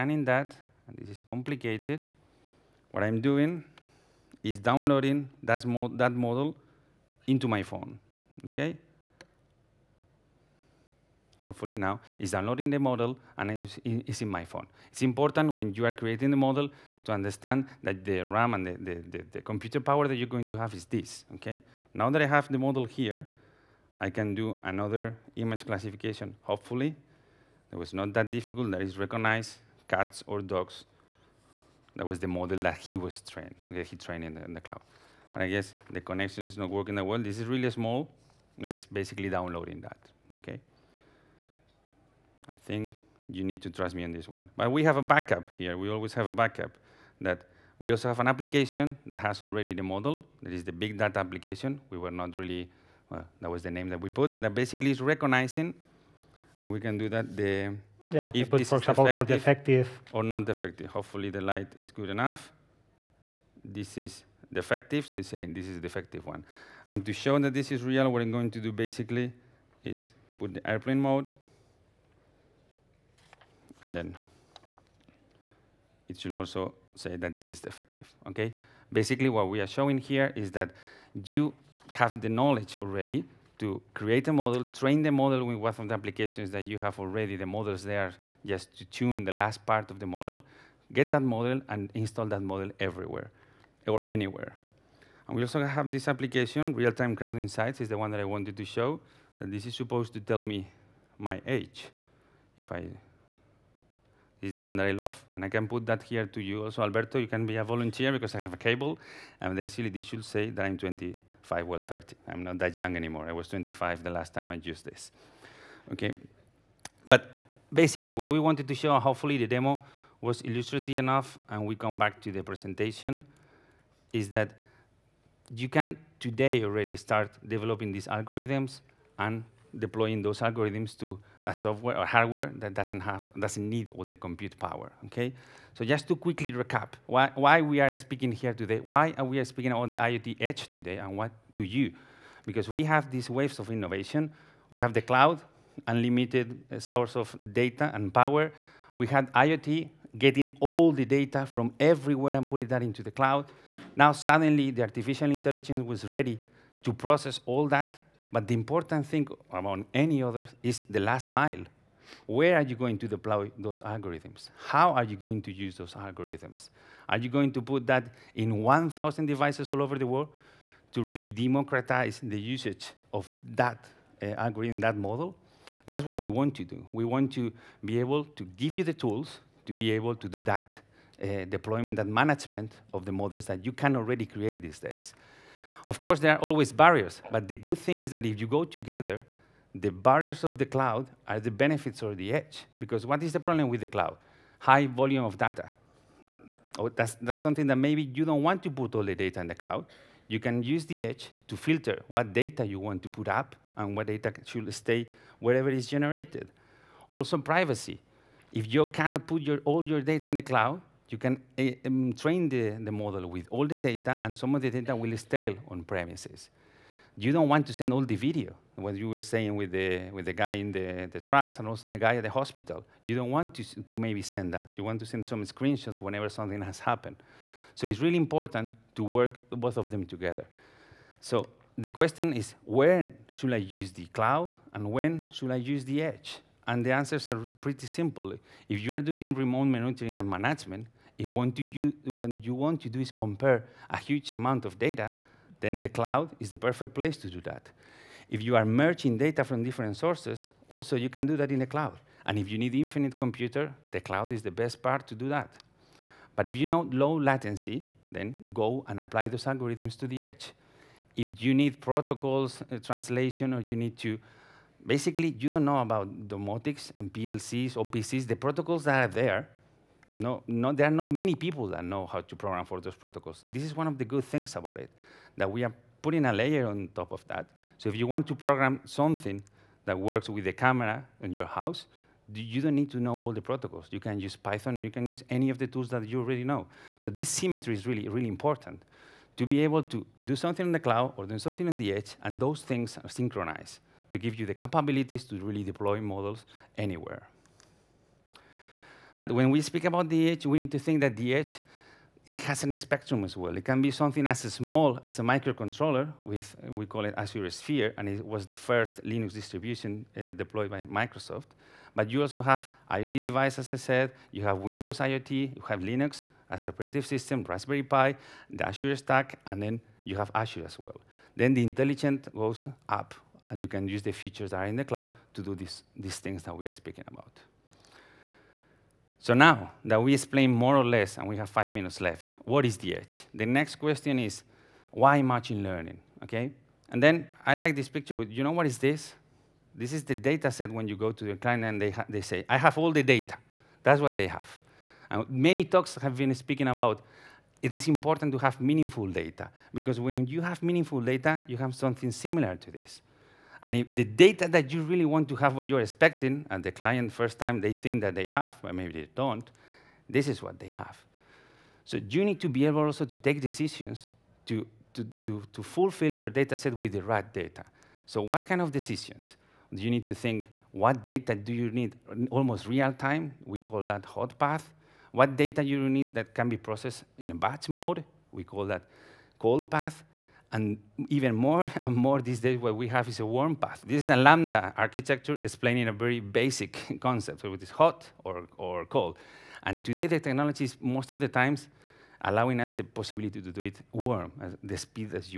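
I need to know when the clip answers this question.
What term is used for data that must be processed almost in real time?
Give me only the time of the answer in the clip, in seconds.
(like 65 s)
374 s.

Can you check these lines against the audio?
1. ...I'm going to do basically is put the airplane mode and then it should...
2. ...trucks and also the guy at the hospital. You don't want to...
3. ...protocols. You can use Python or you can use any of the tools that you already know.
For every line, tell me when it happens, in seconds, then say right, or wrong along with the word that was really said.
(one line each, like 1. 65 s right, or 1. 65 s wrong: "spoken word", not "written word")
1. 68 s right
2. 221 s right
3. 283 s right.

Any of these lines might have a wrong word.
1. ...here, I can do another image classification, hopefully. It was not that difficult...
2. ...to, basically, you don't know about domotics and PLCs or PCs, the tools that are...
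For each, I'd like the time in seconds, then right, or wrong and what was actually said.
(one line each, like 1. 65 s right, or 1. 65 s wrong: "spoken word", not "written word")
1. 22 s right
2. 263 s wrong: "protocols", not "tools".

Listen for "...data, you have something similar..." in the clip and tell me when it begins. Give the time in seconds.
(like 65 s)
351 s.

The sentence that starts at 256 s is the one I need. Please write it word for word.
But if you know low latency, then go and apply those algorithms to the edge.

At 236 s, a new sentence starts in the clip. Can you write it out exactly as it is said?
And the answers are pretty simple.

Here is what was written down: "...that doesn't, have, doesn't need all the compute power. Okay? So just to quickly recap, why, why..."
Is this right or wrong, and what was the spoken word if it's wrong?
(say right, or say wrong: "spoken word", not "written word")
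right.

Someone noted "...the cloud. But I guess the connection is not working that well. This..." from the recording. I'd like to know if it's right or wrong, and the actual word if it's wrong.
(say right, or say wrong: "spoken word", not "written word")
right.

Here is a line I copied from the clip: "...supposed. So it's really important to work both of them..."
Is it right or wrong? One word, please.
wrong.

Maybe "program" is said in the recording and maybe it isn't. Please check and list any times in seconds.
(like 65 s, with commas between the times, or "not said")
272 s, 278 s.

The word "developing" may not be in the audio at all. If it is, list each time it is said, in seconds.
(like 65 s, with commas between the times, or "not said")
127 s.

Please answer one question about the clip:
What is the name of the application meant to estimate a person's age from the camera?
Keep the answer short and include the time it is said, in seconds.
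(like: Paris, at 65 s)
Real-Time Crowd Insights, at 96 s.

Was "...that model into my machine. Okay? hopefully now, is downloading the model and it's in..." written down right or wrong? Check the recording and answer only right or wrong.
wrong.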